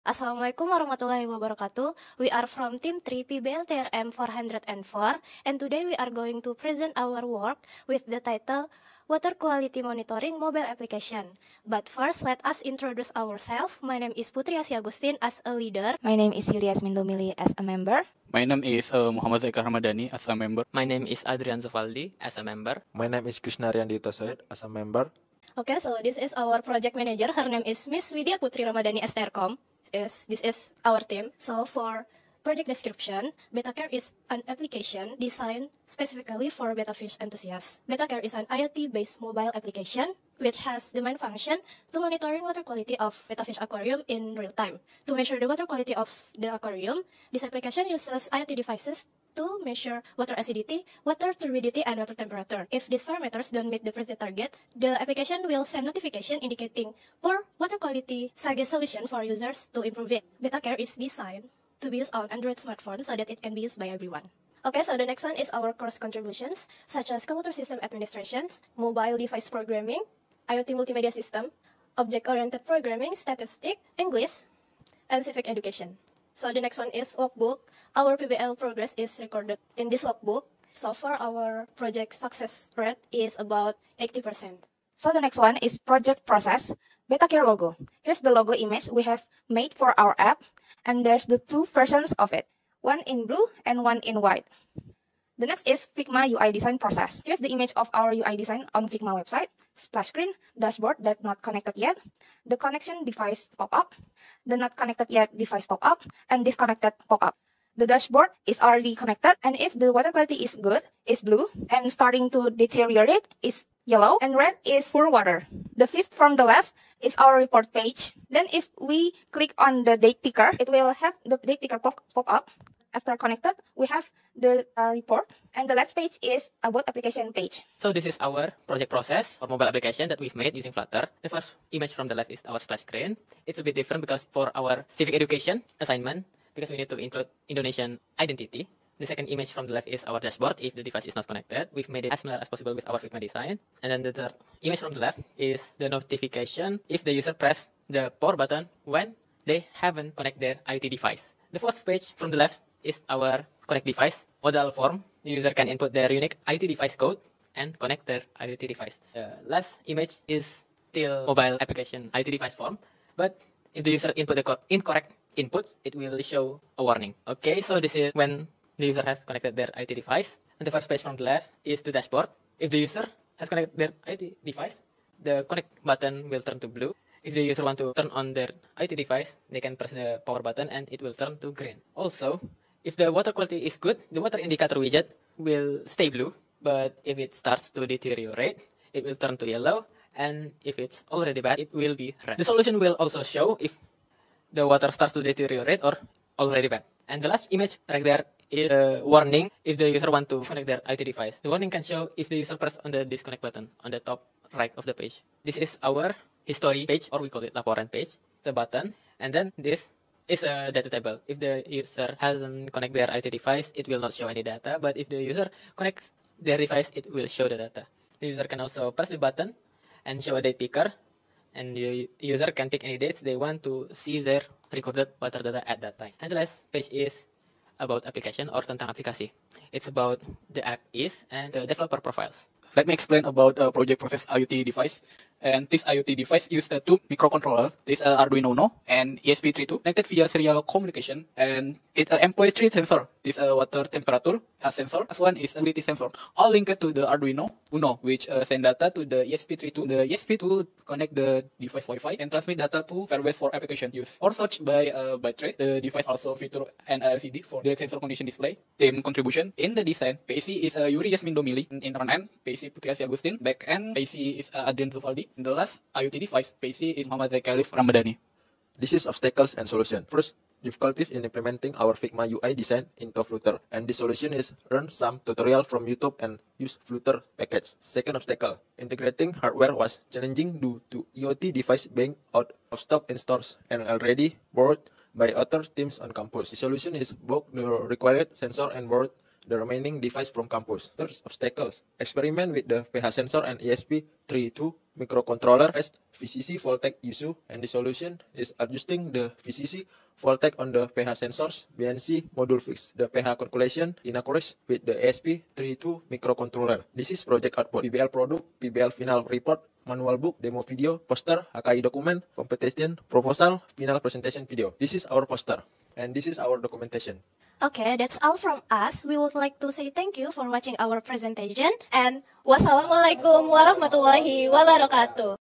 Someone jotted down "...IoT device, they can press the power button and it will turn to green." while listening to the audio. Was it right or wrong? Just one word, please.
right.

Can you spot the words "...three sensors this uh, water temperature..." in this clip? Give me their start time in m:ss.
4:02.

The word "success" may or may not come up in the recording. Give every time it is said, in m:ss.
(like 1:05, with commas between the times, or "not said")
1:22.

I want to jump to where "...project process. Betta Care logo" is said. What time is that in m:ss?
1:25.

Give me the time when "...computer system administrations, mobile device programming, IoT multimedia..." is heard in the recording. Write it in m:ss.
1:07.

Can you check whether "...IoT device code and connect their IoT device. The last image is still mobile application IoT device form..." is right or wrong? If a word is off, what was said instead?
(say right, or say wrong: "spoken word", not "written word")
right.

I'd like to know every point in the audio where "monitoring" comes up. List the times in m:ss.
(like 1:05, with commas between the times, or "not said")
0:09, 0:42.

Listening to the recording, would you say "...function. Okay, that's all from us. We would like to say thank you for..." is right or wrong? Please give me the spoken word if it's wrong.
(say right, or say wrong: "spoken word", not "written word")
wrong: "documentation", not "function".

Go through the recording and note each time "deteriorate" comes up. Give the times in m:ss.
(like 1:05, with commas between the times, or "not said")
1:52, 3:07, 3:15.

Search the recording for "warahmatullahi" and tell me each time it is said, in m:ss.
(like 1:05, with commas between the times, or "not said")
0:00, 5:23.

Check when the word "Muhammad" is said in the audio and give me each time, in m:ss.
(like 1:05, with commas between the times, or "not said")
0:19, 4:27.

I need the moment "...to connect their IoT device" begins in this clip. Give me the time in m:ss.
3:20.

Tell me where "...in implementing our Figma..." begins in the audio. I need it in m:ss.
4:31.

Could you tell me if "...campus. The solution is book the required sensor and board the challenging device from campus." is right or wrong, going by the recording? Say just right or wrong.
wrong.